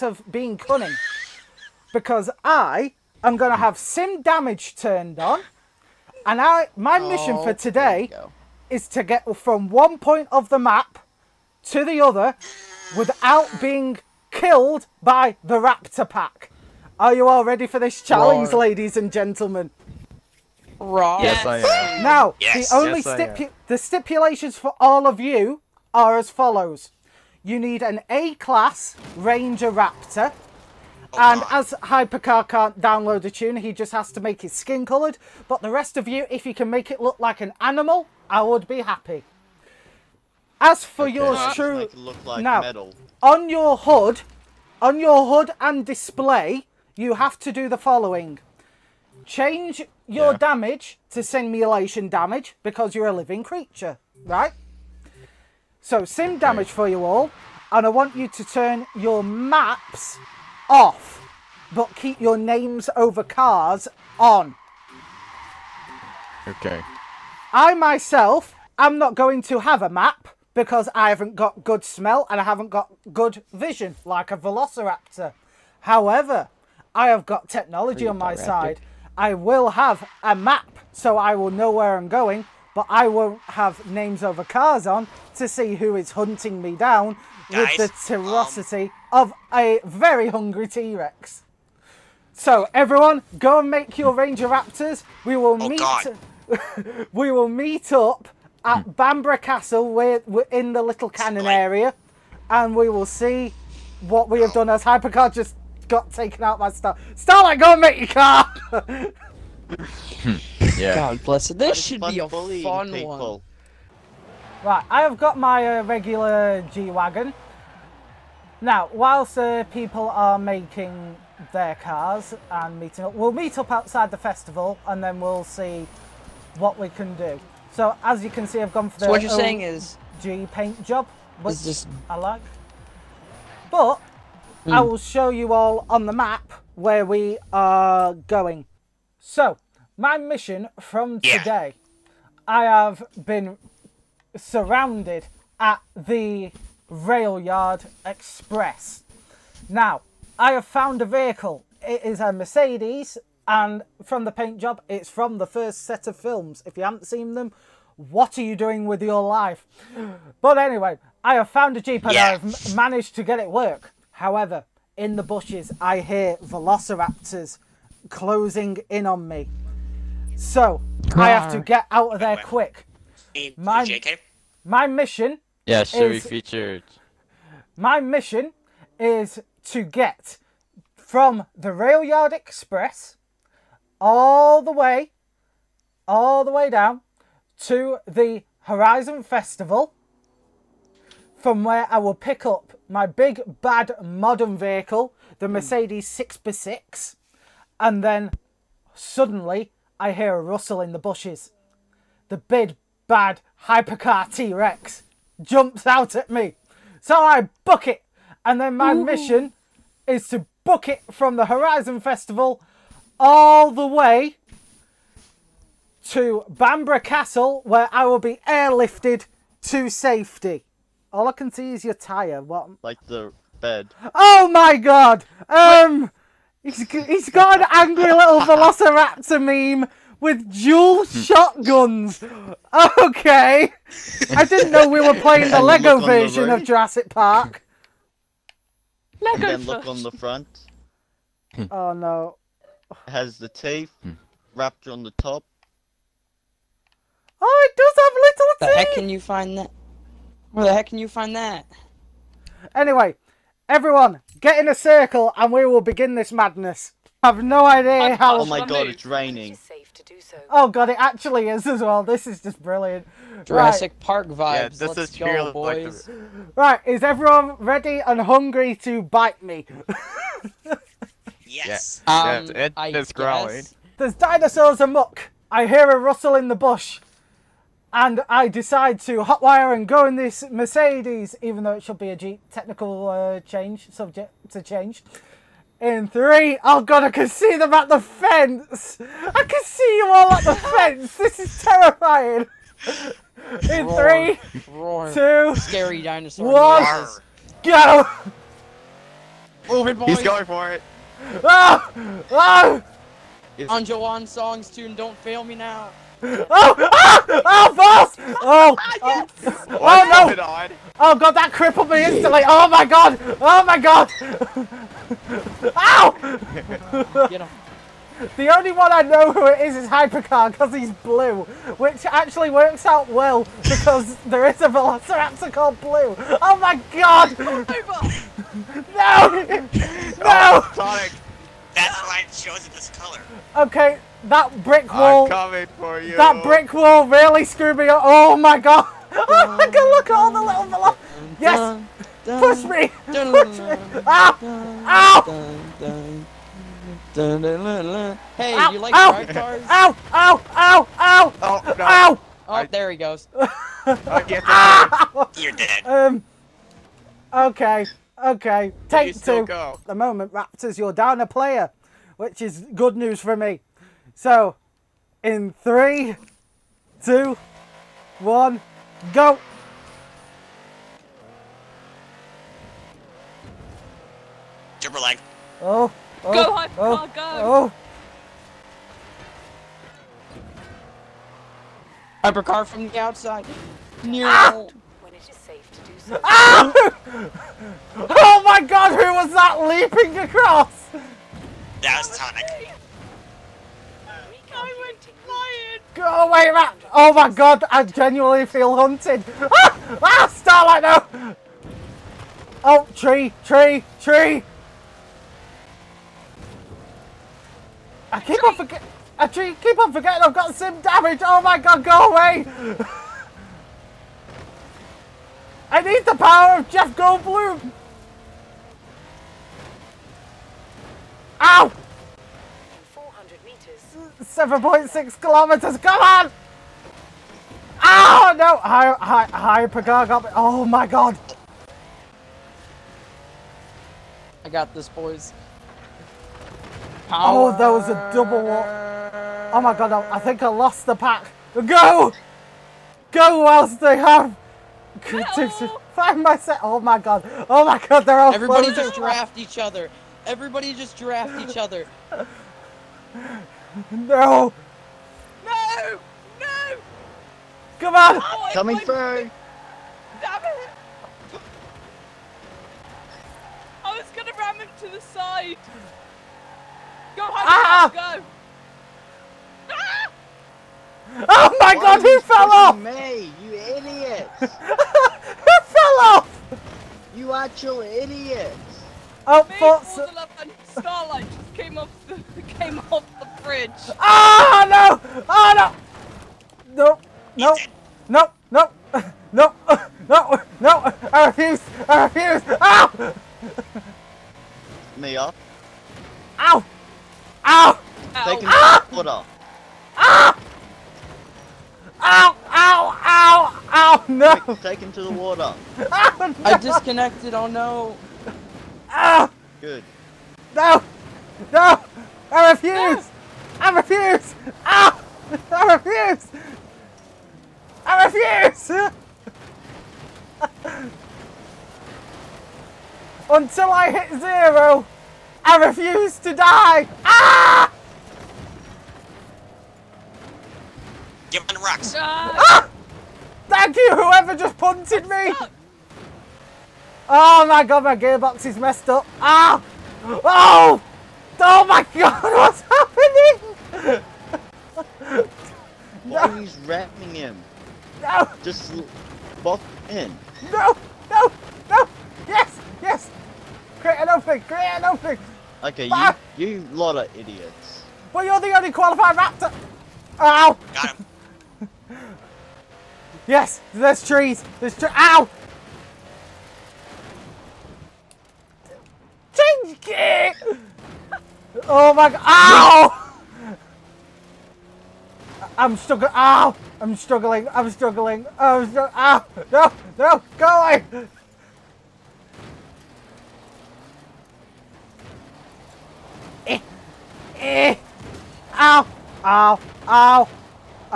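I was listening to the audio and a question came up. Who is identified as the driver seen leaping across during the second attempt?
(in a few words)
Tonic.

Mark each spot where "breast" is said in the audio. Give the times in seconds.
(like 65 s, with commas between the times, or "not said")
not said.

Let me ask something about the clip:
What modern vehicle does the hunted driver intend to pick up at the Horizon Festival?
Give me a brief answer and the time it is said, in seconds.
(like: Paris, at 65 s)
Mercedes 6x6, at 195 s.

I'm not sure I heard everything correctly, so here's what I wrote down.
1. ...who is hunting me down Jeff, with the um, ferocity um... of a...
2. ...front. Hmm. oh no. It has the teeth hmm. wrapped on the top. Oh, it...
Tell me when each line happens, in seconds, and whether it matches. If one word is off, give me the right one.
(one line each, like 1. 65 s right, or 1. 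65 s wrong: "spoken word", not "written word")
1. 85 s wrong: "Guys", not "Jeff"
2. 240 s right.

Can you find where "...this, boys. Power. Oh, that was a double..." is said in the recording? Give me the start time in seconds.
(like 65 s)
434 s.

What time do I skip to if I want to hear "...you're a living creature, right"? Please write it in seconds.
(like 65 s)
52 s.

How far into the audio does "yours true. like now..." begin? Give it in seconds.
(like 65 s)
41 s.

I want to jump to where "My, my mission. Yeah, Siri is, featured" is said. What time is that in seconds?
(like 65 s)
173 s.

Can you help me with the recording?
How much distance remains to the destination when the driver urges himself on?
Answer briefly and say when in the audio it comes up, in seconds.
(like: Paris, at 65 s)
7.6 kilometers, at 424 s.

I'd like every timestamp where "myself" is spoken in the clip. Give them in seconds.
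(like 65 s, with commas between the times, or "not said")
67 s, 446 s.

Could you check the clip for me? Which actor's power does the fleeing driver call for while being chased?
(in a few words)
Jeff Goldblum.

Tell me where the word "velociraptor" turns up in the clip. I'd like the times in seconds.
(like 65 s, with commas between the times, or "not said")
74 s, 166 s, 228 s, 324 s.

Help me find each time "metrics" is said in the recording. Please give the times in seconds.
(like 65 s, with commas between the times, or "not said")
not said.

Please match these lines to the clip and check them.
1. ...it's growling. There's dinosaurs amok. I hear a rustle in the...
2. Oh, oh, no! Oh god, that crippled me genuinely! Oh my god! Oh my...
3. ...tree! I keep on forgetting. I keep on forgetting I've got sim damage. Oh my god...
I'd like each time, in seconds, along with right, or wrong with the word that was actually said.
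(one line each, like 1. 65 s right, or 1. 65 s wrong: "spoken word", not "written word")
1. 272 s right
2. 309 s wrong: "instantly", not "genuinely"
3. 403 s right.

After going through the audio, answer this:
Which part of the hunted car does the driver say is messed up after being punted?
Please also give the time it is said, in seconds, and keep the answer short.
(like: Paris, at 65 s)
gearbox, at 537 s.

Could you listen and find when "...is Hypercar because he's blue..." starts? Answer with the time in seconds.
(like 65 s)
319 s.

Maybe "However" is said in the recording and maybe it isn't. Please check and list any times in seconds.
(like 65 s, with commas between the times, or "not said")
75 s, 164 s.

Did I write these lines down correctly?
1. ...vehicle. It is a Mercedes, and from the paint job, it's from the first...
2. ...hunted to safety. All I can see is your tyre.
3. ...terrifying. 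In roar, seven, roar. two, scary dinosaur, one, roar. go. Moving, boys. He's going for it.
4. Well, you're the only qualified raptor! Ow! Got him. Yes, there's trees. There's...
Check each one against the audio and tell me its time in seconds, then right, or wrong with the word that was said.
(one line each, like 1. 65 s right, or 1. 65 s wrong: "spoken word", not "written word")
1. 151 s right
2. 218 s wrong: "airlifted", not "hunted"
3. 291 s wrong: "three", not "seven"
4. 558 s right.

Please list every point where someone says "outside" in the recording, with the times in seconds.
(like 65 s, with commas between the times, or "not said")
123 s, 382 s.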